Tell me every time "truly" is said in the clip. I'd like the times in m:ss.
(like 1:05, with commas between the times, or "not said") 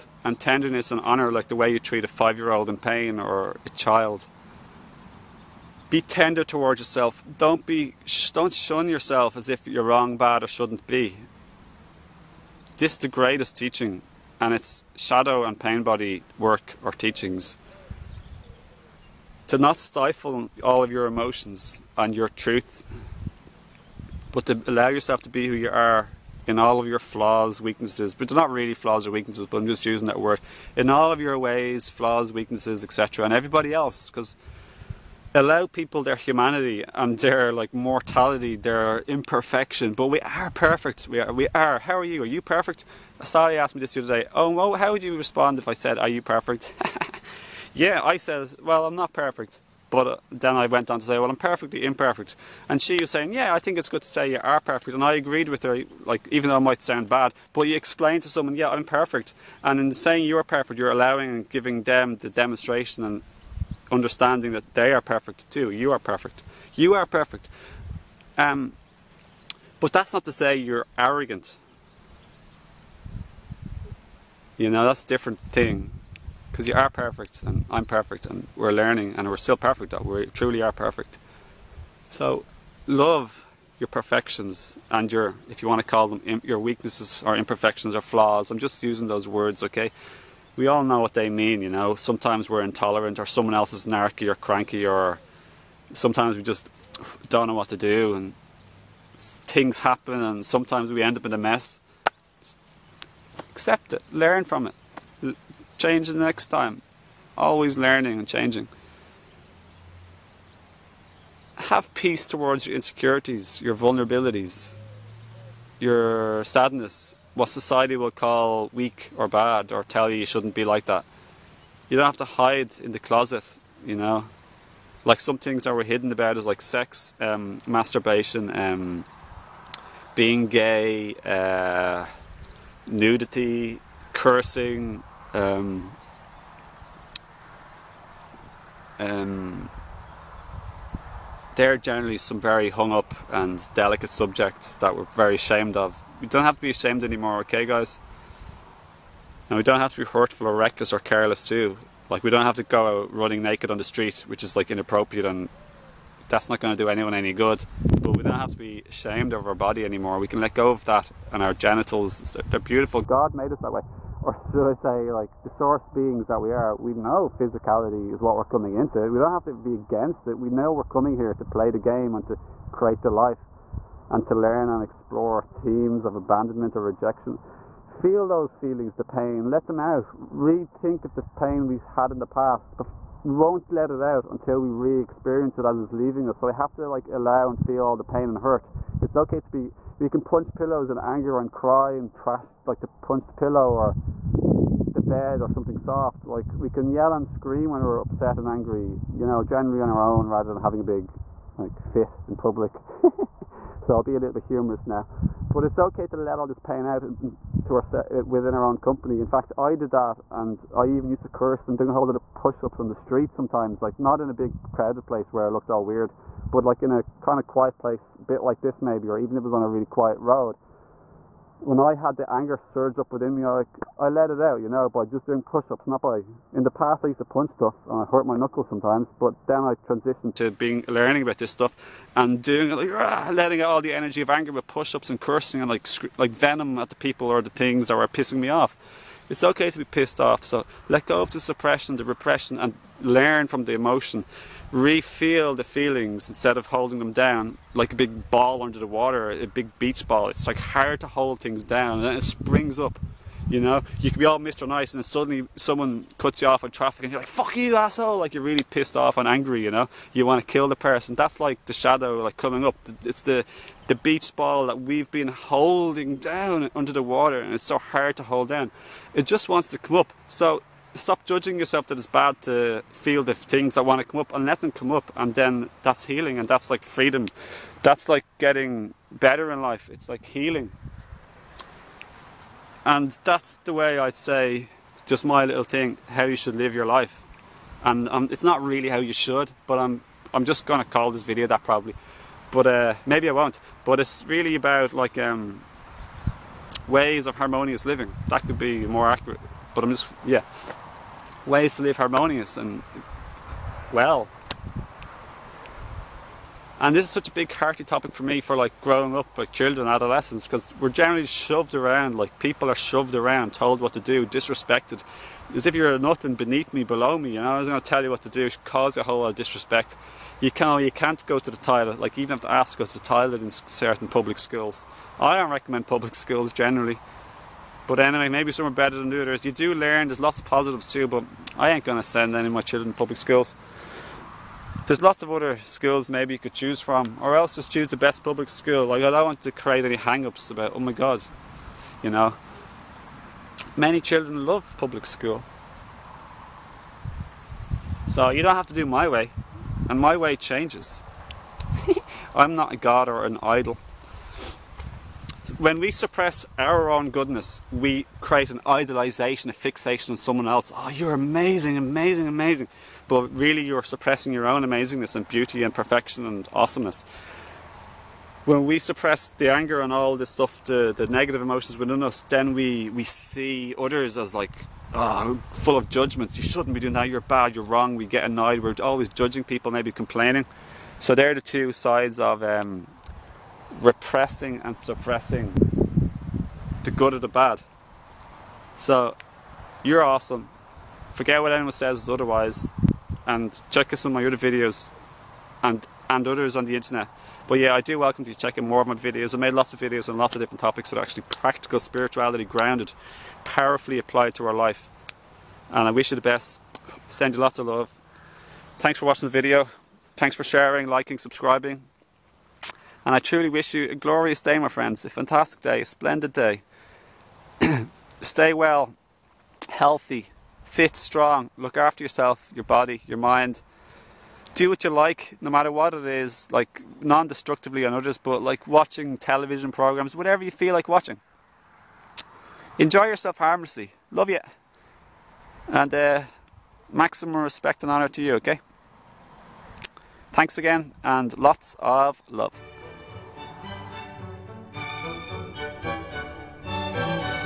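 1:20, 6:53.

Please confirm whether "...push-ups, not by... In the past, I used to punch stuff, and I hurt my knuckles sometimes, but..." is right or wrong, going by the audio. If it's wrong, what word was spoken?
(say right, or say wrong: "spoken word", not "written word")
right.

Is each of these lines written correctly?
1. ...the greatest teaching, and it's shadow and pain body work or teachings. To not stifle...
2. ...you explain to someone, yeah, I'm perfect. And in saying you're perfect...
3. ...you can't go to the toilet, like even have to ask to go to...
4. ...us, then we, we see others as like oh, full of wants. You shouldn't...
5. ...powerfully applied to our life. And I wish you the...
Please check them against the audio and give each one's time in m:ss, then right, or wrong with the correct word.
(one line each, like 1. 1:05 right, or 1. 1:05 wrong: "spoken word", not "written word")
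1. 0:12 right
2. 0:57 right
3. 5:20 right
4. 6:12 wrong: "judgments", not "wants"
5. 6:43 right.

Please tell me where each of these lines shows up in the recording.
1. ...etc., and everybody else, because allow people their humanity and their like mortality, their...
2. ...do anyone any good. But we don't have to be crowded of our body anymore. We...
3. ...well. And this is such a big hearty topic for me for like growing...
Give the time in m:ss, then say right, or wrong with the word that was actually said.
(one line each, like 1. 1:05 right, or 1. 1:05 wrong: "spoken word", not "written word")
1. 0:32 right
2. 2:36 wrong: "ashamed", not "crowded"
3. 5:03 right.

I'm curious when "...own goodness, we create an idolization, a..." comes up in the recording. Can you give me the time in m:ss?
5:56.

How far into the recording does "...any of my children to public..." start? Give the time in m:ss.
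5:32.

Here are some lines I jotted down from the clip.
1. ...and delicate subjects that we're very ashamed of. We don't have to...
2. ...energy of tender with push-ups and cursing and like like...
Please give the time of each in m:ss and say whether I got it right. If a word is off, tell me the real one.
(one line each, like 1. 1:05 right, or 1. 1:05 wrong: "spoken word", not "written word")
1. 2:23 right
2. 3:53 wrong: "anger", not "tender".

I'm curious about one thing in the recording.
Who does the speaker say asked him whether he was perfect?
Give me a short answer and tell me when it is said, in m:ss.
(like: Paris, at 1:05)
Sally, at 0:43.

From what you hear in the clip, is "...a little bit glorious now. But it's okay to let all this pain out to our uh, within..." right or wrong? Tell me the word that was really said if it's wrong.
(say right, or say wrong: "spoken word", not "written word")
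wrong: "humorous", not "glorious".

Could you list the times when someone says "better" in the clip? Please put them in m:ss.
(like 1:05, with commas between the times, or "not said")
4:39, 5:28.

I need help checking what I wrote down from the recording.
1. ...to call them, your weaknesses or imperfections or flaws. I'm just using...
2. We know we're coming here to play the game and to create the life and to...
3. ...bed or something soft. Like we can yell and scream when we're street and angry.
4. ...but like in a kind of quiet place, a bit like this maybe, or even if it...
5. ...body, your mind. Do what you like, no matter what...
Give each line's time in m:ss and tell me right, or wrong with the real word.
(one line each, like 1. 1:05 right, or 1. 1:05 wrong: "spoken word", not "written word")
1. 1:25 right
2. 2:50 right
3. 3:15 wrong: "upset", not "street"
4. 3:36 right
5. 7:02 right.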